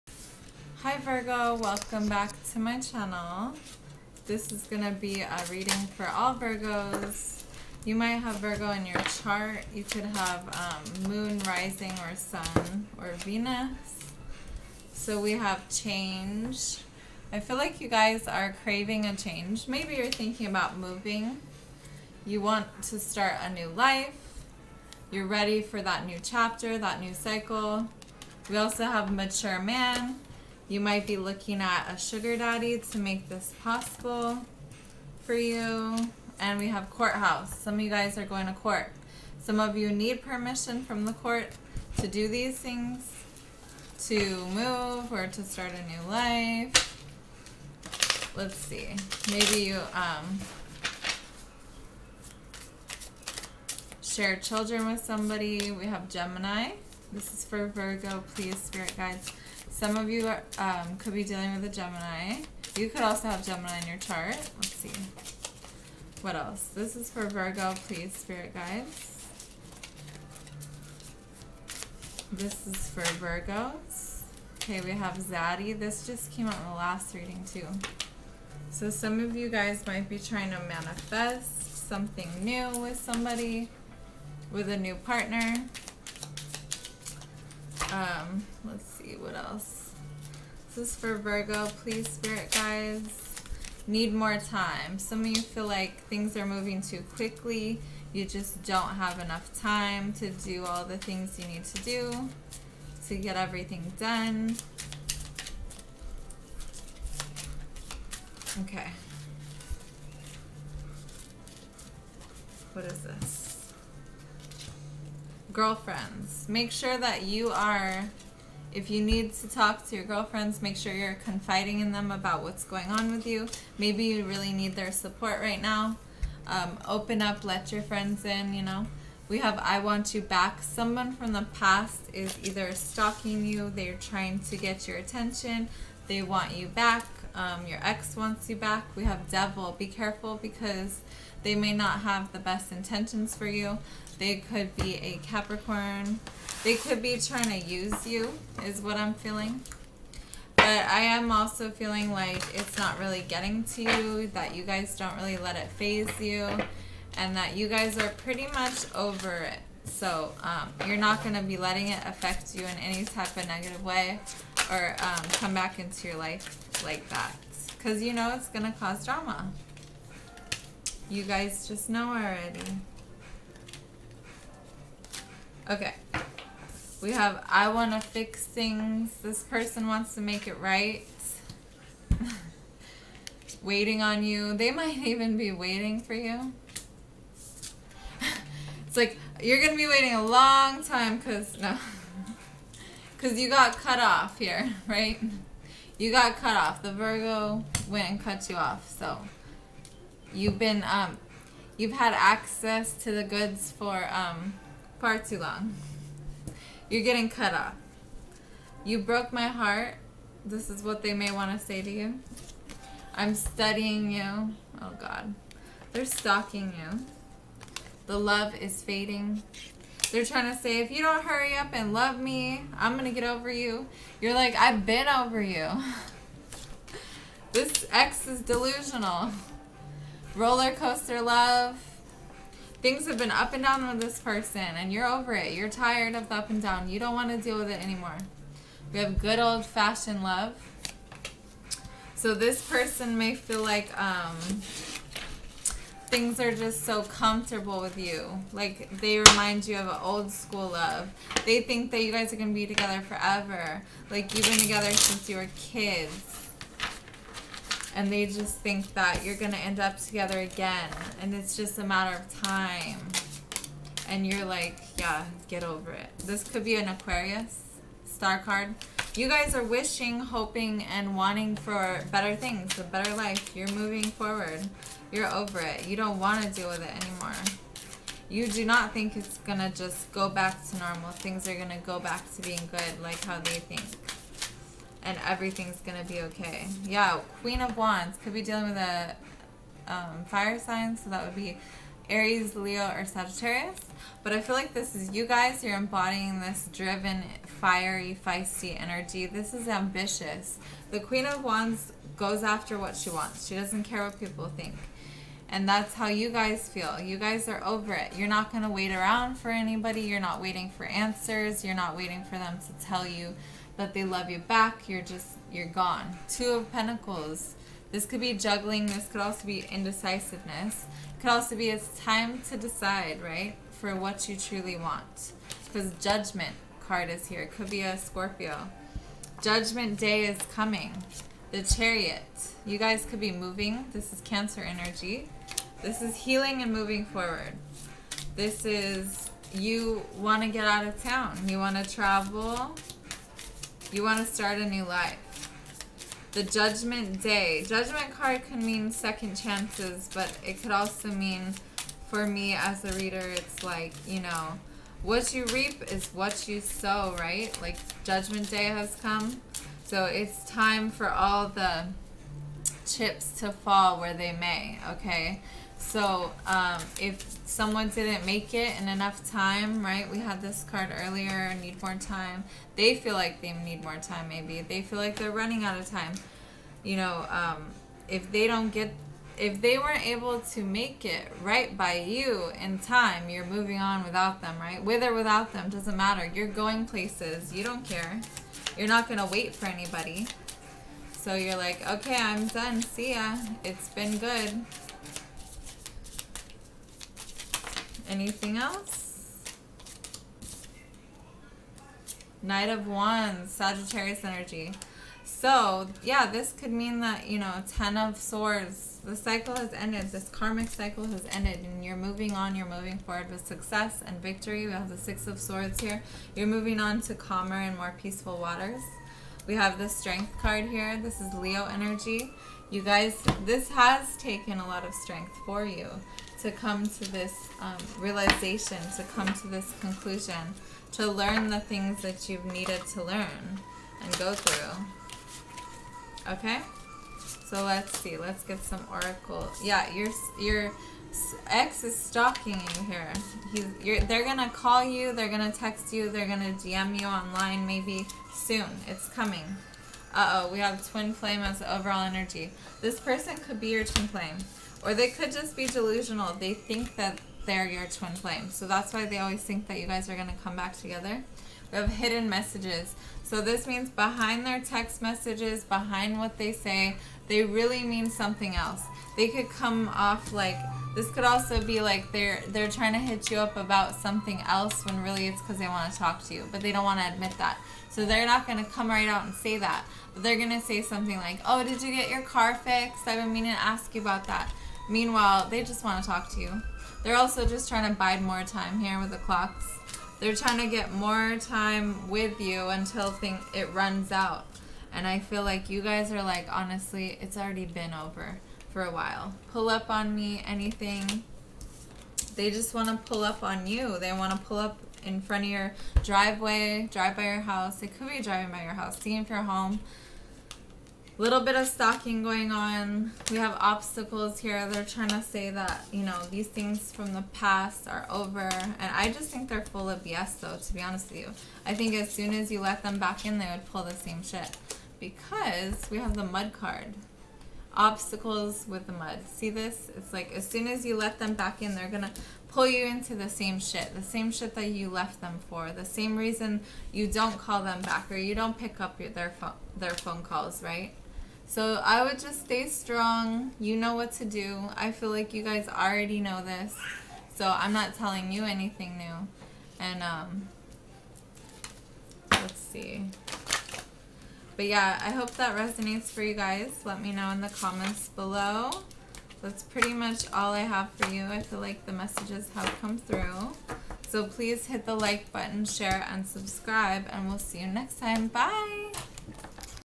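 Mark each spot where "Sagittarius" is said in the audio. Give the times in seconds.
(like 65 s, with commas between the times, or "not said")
293 s, 403 s.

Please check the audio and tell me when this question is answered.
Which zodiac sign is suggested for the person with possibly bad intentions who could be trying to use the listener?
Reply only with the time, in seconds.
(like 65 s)
145 s.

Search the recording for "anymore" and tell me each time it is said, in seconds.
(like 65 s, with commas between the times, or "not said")
237 s, 277 s.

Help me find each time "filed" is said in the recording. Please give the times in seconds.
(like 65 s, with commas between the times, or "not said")
not said.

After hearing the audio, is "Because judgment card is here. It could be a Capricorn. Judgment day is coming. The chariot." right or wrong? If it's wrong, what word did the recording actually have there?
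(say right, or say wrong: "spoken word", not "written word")
wrong: "Scorpio", not "Capricorn".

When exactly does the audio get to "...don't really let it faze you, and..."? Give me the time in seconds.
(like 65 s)
154 s.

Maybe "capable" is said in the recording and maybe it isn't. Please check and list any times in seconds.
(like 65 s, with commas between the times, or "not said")
not said.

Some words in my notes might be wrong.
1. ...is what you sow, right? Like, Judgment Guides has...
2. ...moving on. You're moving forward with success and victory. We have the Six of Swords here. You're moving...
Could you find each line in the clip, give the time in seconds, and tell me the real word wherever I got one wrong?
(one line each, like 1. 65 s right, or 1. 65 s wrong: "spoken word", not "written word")
1. 355 s wrong: "Day", not "Guides"
2. 411 s right.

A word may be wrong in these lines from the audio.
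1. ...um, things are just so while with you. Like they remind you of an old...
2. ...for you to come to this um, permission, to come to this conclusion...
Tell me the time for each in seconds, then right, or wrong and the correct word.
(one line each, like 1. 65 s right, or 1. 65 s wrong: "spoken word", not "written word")
1. 244 s wrong: "comfortable", not "while"
2. 425 s wrong: "realization", not "permission".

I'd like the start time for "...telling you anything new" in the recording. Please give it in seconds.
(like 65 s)
547 s.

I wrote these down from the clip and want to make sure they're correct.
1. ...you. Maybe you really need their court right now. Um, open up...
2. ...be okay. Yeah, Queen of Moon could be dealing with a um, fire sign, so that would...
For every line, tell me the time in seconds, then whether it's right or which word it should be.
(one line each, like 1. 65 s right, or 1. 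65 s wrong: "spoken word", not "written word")
1. 123 s wrong: "support", not "court"
2. 286 s wrong: "Wands", not "Moon".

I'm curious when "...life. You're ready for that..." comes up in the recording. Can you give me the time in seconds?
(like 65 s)
23 s.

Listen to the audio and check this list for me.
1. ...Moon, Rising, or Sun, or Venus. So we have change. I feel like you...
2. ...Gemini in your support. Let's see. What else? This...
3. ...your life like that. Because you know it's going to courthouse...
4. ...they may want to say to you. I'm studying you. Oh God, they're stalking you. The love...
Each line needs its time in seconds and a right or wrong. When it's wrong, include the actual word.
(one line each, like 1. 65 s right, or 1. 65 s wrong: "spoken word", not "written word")
1. 11 s right
2. 63 s wrong: "chart", not "support"
3. 166 s wrong: "cause", not "courthouse"
4. 211 s right.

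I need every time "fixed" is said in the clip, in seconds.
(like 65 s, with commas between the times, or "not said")
482 s.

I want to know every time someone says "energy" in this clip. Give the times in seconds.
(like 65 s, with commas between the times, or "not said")
298 s, 334 s, 404 s, 421 s, 452 s.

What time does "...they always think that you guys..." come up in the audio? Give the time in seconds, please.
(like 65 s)
459 s.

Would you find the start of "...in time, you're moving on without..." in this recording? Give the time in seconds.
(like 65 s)
382 s.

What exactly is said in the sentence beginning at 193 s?
cuz you got cut off here, right?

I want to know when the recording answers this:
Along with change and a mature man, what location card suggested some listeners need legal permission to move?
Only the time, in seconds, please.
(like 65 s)
36 s.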